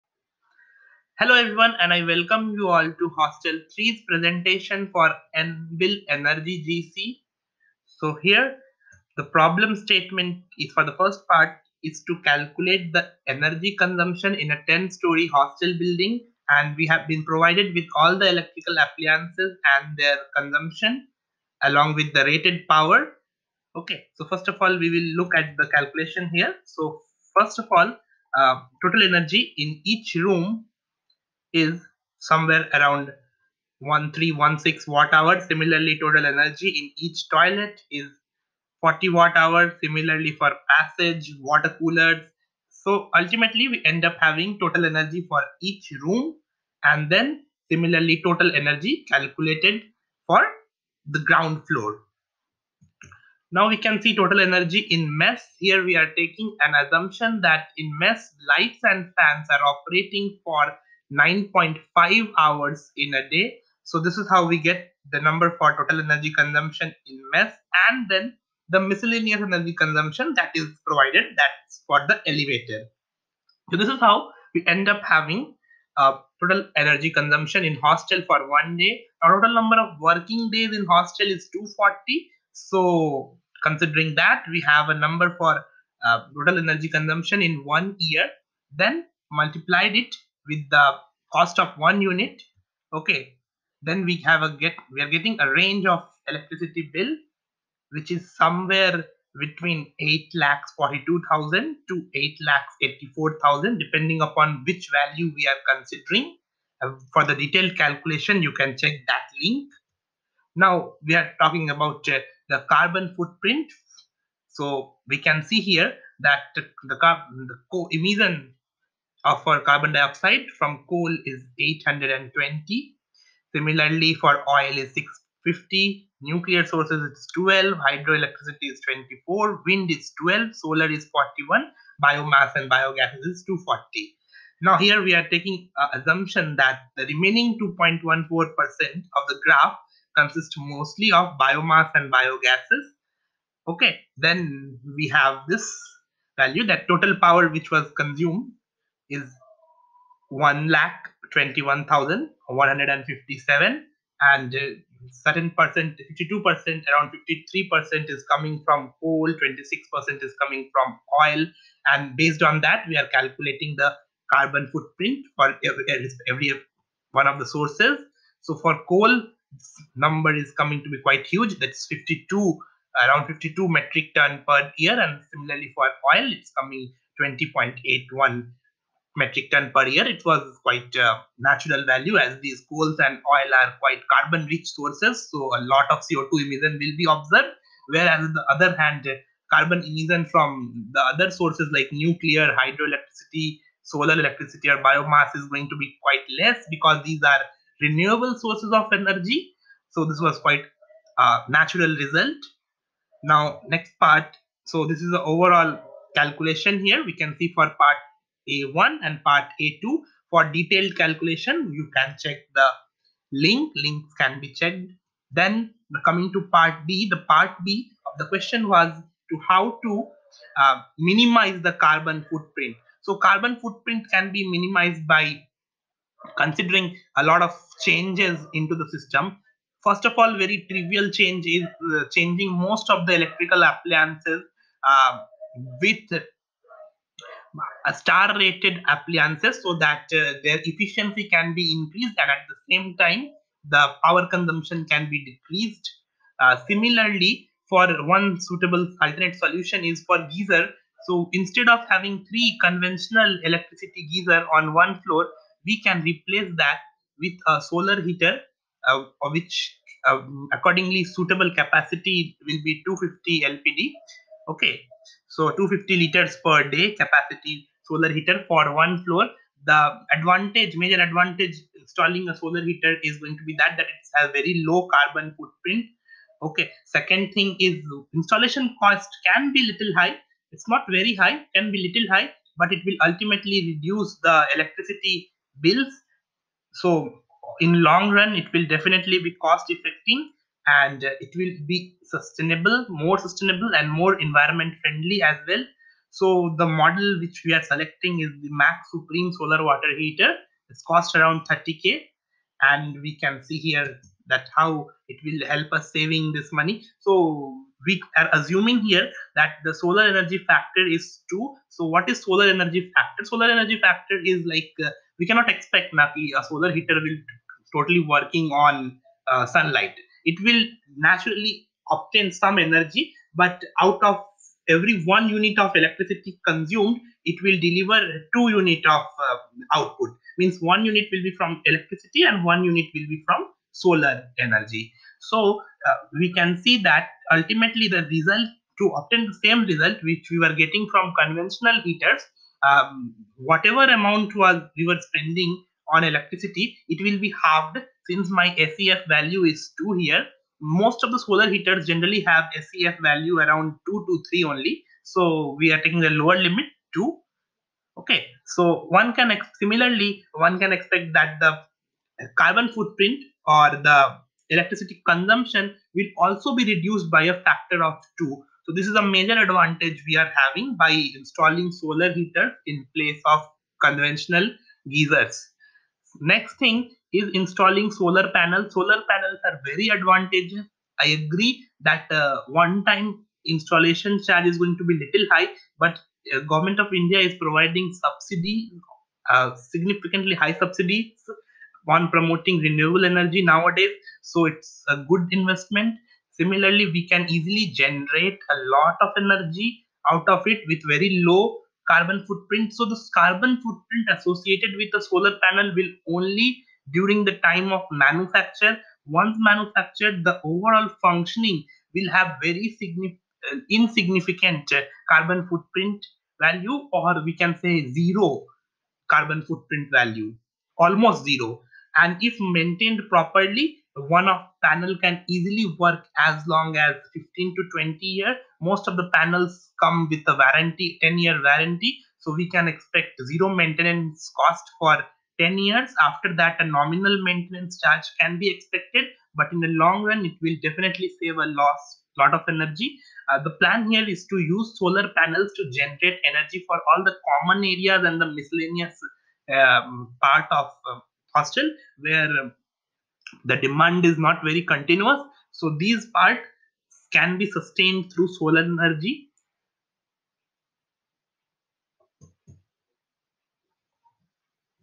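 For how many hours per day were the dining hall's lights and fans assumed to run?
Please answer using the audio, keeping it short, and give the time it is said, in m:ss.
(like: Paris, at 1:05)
9.5 hours, at 1:01.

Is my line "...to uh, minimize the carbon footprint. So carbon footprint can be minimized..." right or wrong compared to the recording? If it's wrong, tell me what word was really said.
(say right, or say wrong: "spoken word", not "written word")
right.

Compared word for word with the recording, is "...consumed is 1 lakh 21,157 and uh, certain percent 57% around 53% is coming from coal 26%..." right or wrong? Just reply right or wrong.
wrong.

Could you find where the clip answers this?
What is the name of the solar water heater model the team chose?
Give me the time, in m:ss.
4:58.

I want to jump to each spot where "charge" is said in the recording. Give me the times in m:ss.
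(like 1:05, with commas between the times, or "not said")
6:24, 7:17.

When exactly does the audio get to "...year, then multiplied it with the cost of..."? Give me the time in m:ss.
1:27.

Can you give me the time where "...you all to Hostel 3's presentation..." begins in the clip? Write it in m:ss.
0:02.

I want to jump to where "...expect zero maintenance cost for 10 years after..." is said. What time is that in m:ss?
7:12.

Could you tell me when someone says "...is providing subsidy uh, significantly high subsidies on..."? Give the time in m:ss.
6:27.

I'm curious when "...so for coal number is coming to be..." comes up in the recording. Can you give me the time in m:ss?
2:48.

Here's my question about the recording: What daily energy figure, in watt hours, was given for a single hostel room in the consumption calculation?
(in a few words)
1316 watt hours.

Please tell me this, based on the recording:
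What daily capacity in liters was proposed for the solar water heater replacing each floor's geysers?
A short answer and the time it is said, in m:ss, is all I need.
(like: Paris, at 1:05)
250 LPD, at 4:22.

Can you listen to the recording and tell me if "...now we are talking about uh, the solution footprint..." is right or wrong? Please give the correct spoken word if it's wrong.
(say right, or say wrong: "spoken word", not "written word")
wrong: "carbon", not "solution".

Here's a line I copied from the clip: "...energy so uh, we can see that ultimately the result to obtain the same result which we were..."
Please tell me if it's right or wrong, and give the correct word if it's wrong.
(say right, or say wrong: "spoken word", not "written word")
right.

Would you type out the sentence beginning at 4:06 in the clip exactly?
Uh, similarly, for one suitable alternate solution is for geyser.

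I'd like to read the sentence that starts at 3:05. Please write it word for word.
So a lot of CO2 emission will be observed.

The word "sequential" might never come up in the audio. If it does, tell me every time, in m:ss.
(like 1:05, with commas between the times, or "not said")
not said.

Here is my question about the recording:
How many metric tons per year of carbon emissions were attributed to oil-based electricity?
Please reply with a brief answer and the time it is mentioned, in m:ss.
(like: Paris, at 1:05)
20.81, at 2:57.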